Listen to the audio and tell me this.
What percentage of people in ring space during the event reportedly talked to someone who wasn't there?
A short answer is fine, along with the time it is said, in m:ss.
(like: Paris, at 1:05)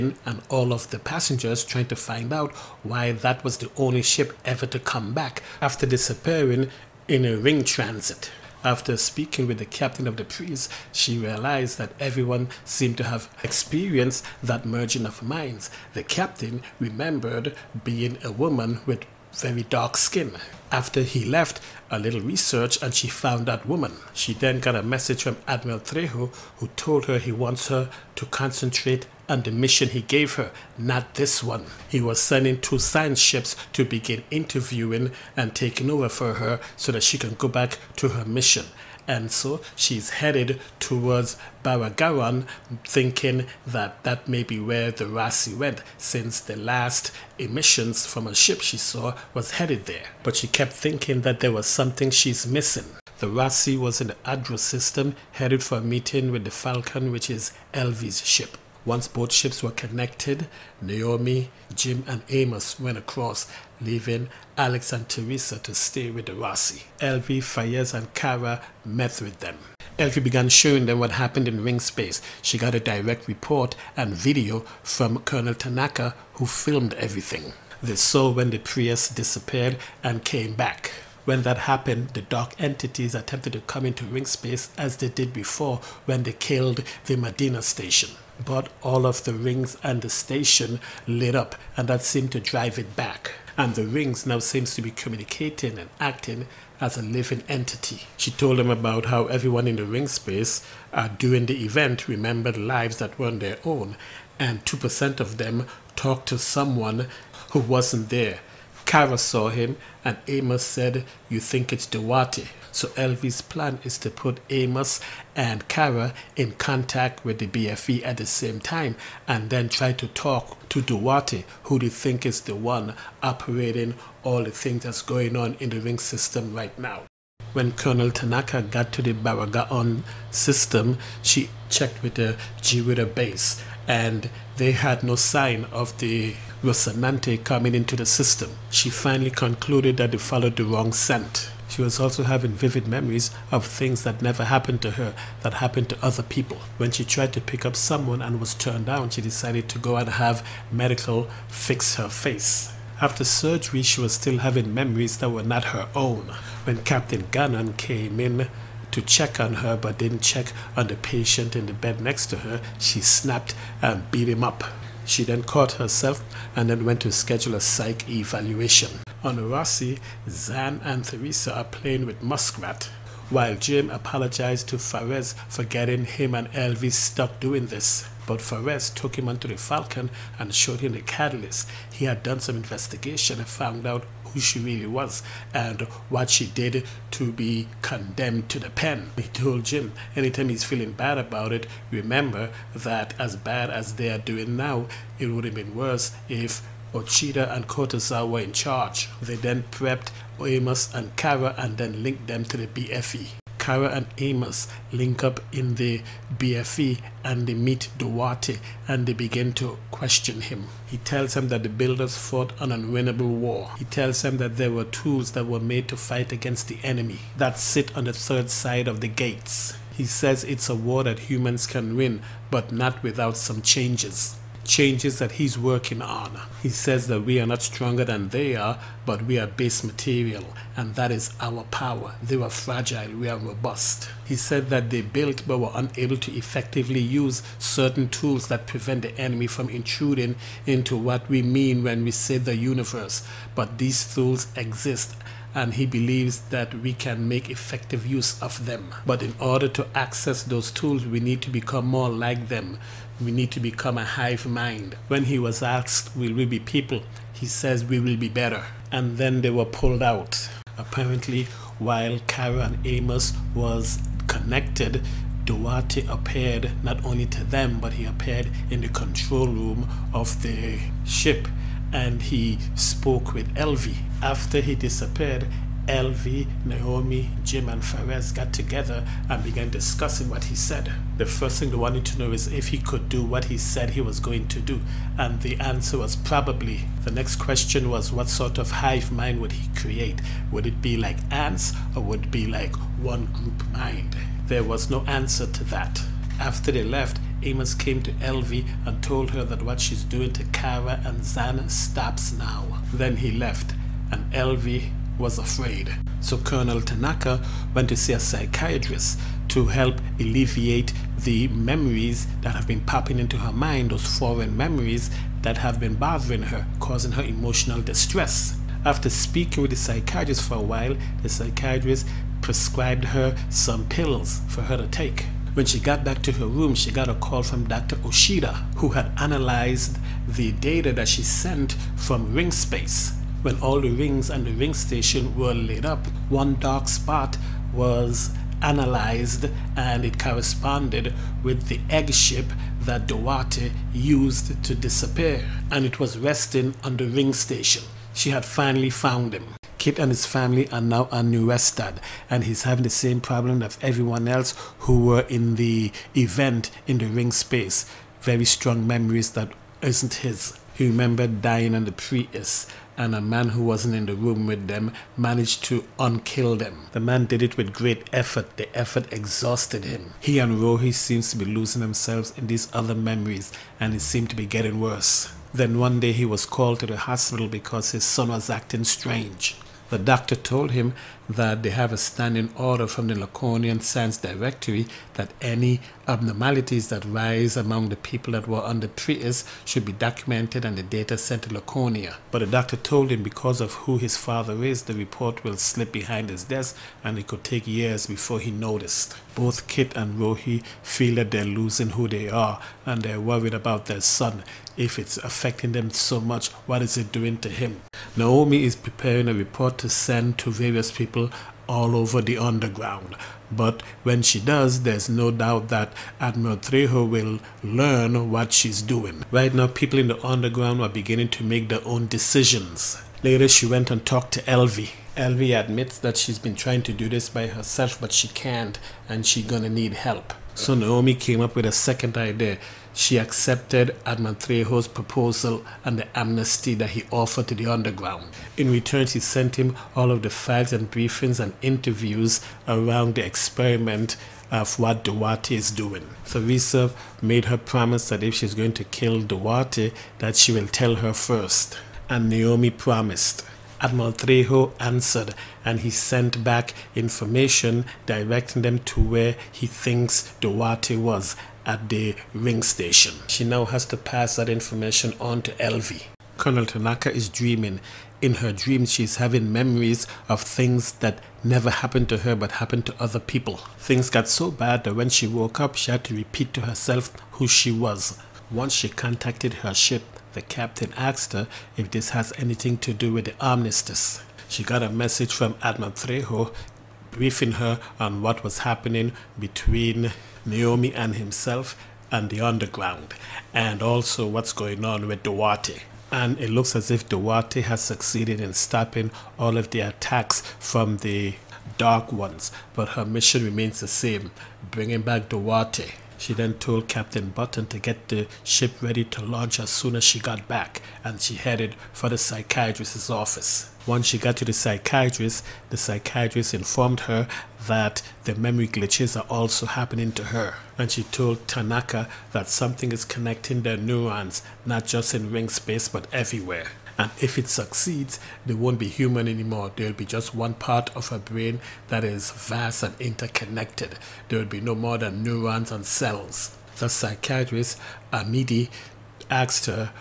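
2%, at 1:44.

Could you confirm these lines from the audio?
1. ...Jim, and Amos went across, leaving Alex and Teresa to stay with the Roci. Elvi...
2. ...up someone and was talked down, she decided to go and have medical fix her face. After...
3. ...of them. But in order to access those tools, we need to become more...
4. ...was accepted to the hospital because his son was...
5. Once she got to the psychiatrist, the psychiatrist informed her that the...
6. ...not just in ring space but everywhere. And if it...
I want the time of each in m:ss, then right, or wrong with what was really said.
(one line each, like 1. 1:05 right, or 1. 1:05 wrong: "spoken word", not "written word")
1. 1:01 right
2. 2:27 wrong: "turned", not "talked"
3. 4:08 right
4. 6:16 wrong: "called", not "accepted"
5. 8:33 right
6. 8:44 right.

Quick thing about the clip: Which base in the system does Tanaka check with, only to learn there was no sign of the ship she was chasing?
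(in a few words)
Jiwira.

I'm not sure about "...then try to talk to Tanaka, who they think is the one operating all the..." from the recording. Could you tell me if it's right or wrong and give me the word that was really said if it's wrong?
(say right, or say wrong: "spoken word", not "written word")
wrong: "Duarte", not "Tanaka".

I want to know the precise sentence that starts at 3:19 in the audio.
They then prepped Amos and Cara and then linked them to the BFE.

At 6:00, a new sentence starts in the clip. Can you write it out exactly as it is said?
He remembered dying on the Prius, and a man who wasn't in the room with them managed to unkill them.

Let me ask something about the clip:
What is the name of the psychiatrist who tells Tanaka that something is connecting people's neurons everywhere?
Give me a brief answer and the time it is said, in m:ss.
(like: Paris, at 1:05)
Amidi, at 8:58.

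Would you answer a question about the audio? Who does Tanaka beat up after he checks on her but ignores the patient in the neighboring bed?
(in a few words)
Captain Gannon.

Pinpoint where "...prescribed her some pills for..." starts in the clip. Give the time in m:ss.
5:22.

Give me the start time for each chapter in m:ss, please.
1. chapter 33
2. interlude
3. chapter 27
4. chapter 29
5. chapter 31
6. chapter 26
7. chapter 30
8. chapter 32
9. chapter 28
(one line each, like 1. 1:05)
1. 6:48
2. 3:24
3. 1:10
4. 2:49
5. 5:06
6. 0:53
7. 4:19
8. 5:50
9. 2:07.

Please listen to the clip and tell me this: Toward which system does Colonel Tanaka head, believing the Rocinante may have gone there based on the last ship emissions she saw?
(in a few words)
Baragaran.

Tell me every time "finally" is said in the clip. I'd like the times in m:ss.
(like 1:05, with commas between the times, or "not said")
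2:18, 5:48.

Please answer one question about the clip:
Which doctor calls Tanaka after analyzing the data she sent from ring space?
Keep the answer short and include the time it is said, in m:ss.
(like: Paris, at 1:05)
Dr. Oshida, at 5:27.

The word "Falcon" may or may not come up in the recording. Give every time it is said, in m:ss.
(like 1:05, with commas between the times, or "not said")
0:56, 2:59.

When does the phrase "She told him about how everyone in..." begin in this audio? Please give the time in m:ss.
1:38.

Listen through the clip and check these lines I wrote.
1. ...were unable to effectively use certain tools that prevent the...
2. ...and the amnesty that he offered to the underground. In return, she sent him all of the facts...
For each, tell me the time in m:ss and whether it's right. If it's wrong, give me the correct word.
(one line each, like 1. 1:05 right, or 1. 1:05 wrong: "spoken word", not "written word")
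1. 3:55 right
2. 7:15 right.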